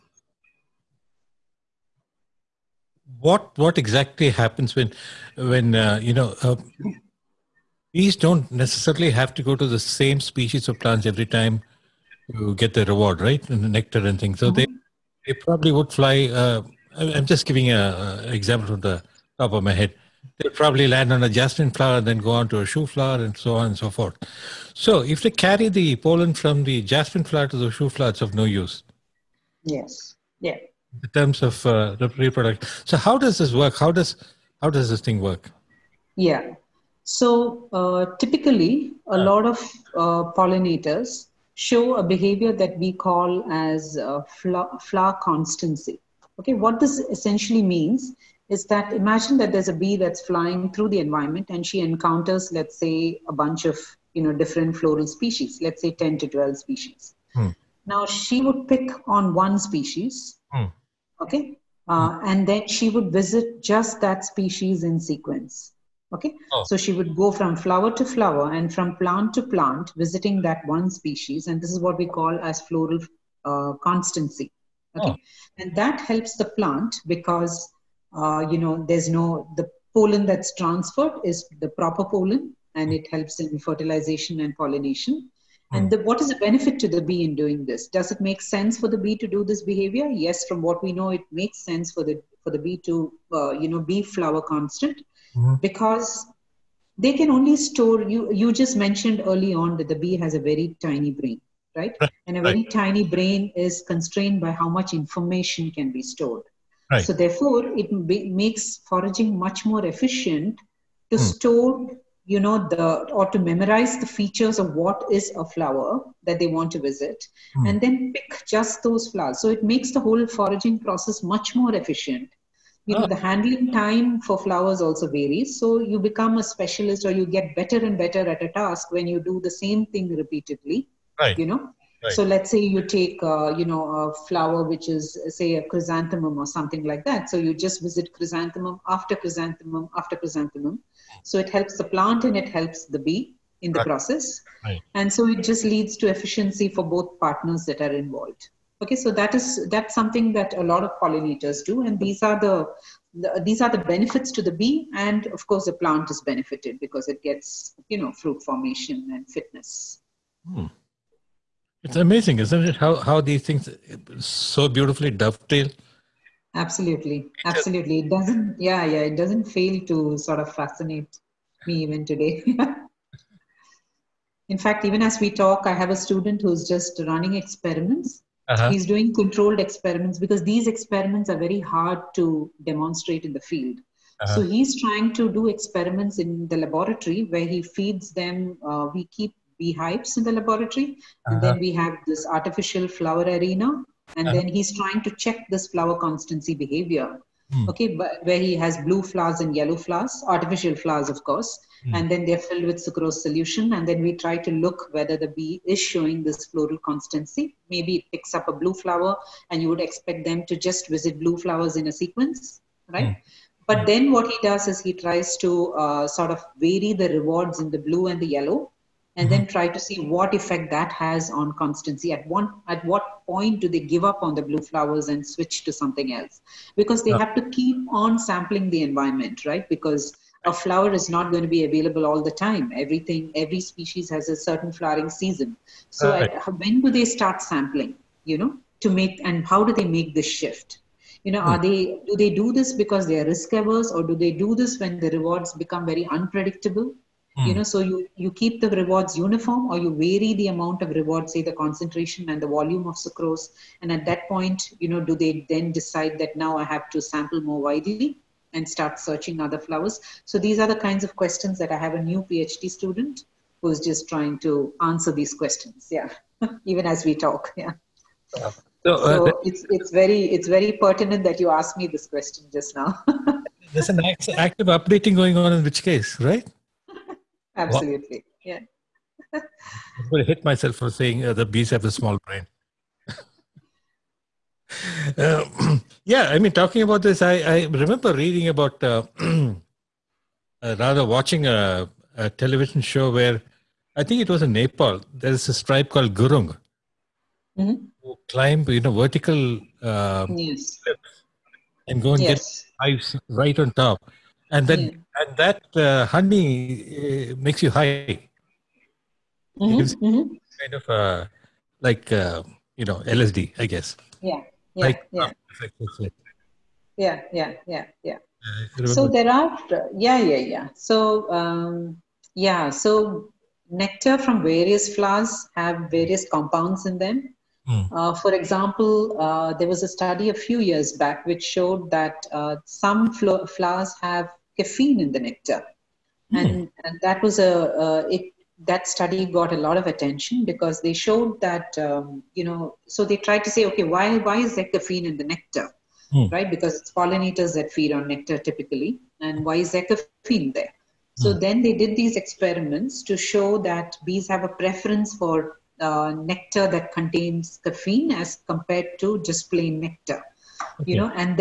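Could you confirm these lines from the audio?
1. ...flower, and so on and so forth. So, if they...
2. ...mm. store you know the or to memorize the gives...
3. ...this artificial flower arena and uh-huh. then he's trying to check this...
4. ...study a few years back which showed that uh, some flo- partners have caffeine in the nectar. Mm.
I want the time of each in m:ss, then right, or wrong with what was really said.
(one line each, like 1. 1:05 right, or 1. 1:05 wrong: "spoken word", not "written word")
1. 0:22 right
2. 1:51 wrong: "features", not "gives"
3. 3:12 right
4. 5:29 wrong: "flowers", not "partners".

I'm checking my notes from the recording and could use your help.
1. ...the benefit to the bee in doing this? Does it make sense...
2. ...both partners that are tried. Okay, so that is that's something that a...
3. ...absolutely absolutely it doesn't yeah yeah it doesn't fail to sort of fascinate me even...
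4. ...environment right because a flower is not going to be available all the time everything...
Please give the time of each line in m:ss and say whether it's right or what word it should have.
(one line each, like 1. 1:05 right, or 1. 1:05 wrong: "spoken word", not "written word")
1. 1:26 right
2. 2:26 wrong: "involved", not "tried"
3. 2:46 right
4. 3:48 right.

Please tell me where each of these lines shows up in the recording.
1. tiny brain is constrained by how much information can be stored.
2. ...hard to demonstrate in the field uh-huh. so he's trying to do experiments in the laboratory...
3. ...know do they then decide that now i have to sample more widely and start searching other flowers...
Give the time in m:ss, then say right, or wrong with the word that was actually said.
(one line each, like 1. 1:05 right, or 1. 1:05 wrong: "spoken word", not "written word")
1. 1:42 right
2. 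3:01 right
3. 4:14 right.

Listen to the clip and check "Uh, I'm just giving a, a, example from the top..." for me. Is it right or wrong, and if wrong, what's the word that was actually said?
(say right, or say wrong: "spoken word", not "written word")
right.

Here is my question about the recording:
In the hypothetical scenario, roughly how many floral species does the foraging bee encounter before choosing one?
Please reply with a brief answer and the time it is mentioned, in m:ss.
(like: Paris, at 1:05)
10 to 12, at 0:55.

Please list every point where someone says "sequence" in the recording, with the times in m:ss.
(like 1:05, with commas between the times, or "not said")
1:04, 3:31.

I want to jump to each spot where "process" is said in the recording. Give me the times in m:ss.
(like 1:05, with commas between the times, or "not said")
2:00, 2:23.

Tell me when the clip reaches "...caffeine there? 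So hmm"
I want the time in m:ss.
5:49.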